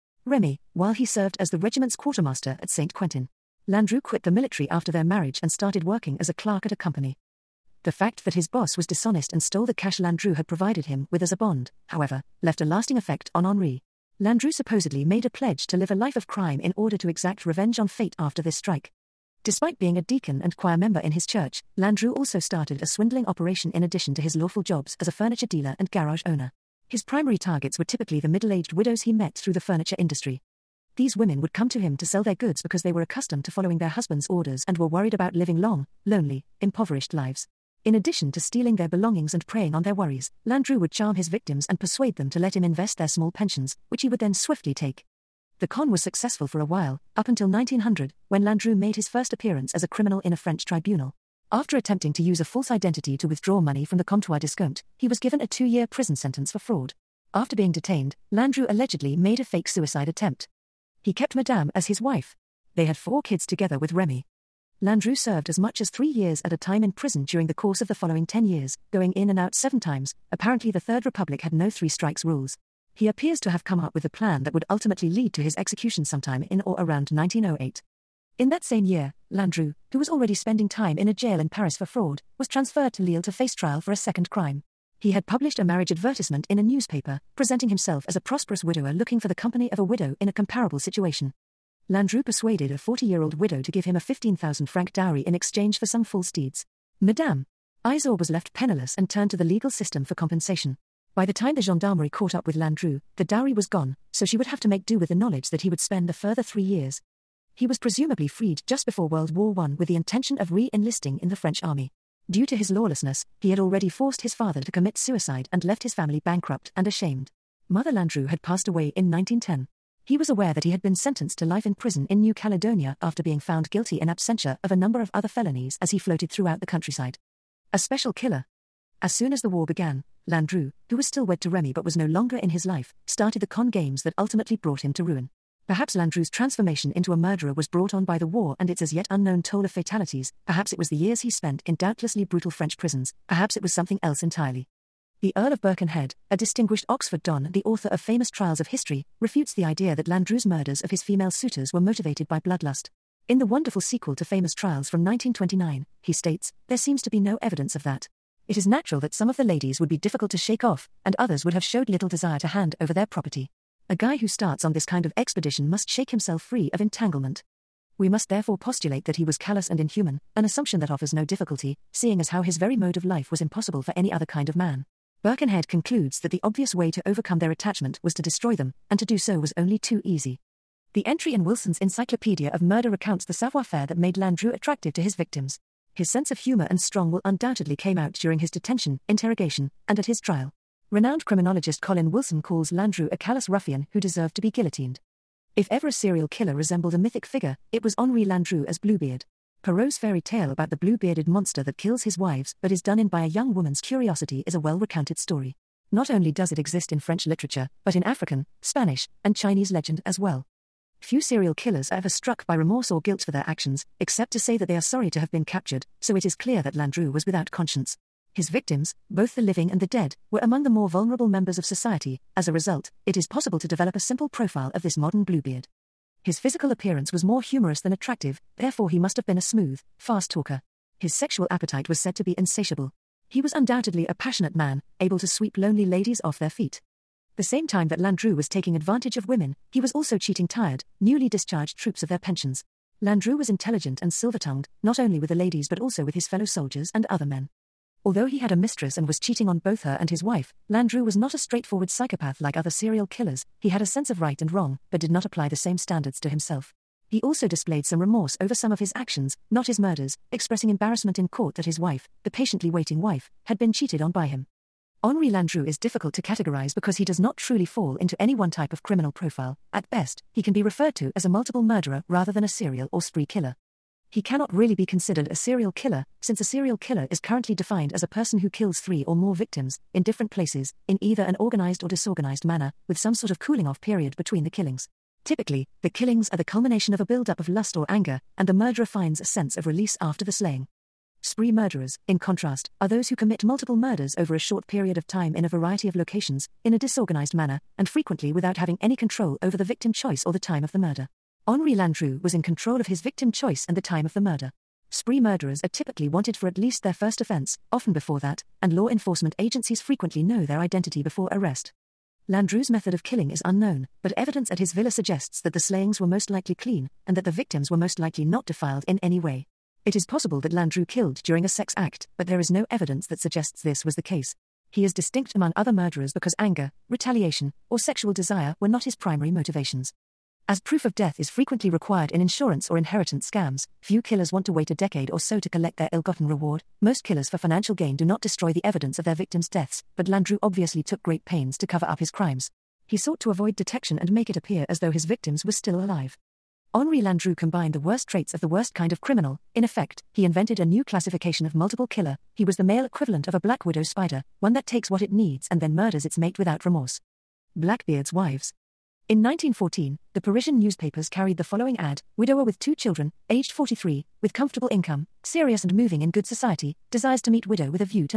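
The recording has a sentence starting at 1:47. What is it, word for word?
He was presumably freed just before World War I with the intention of re enlisting in the French army.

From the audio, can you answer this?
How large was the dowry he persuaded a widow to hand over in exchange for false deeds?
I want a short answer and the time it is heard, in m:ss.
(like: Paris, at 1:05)
15,000 francs, at 1:34.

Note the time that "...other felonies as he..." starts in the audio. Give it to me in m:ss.
2:05.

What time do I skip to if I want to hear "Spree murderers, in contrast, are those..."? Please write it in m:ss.
4:51.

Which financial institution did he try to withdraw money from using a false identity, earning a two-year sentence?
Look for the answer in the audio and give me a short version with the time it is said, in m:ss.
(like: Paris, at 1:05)
Comptoir d'Escompte, at 0:54.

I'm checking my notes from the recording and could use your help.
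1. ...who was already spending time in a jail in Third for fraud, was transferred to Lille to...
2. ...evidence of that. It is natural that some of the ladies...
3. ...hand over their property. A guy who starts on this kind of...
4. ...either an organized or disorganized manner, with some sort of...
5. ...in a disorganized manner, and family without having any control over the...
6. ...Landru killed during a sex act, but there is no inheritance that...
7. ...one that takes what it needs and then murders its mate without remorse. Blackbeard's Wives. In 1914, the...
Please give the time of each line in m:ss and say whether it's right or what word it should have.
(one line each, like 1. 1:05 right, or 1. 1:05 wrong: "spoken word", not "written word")
1. 1:19 wrong: "Paris", not "Third"
2. 2:37 right
3. 2:42 right
4. 4:41 right
5. 4:56 wrong: "frequently", not "family"
6. 5:20 wrong: "evidence", not "inheritance"
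7. 5:54 right.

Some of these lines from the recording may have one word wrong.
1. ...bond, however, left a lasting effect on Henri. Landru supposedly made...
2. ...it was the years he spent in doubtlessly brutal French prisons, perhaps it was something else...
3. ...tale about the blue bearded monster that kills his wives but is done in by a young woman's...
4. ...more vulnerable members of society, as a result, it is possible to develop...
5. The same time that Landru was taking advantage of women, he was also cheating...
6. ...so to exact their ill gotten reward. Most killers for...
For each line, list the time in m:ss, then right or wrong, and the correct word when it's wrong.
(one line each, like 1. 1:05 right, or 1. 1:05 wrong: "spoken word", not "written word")
1. 0:11 right
2. 2:20 right
3. 3:20 right
4. 3:40 right
5. 3:57 right
6. 5:35 wrong: "collect", not "exact".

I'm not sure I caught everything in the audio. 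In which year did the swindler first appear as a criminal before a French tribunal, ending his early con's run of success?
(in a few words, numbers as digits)
1900.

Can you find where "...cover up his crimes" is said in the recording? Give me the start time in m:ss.
5:41.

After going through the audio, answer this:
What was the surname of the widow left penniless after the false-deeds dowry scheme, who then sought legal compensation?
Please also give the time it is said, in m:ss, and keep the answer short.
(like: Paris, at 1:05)
Isor, at 1:37.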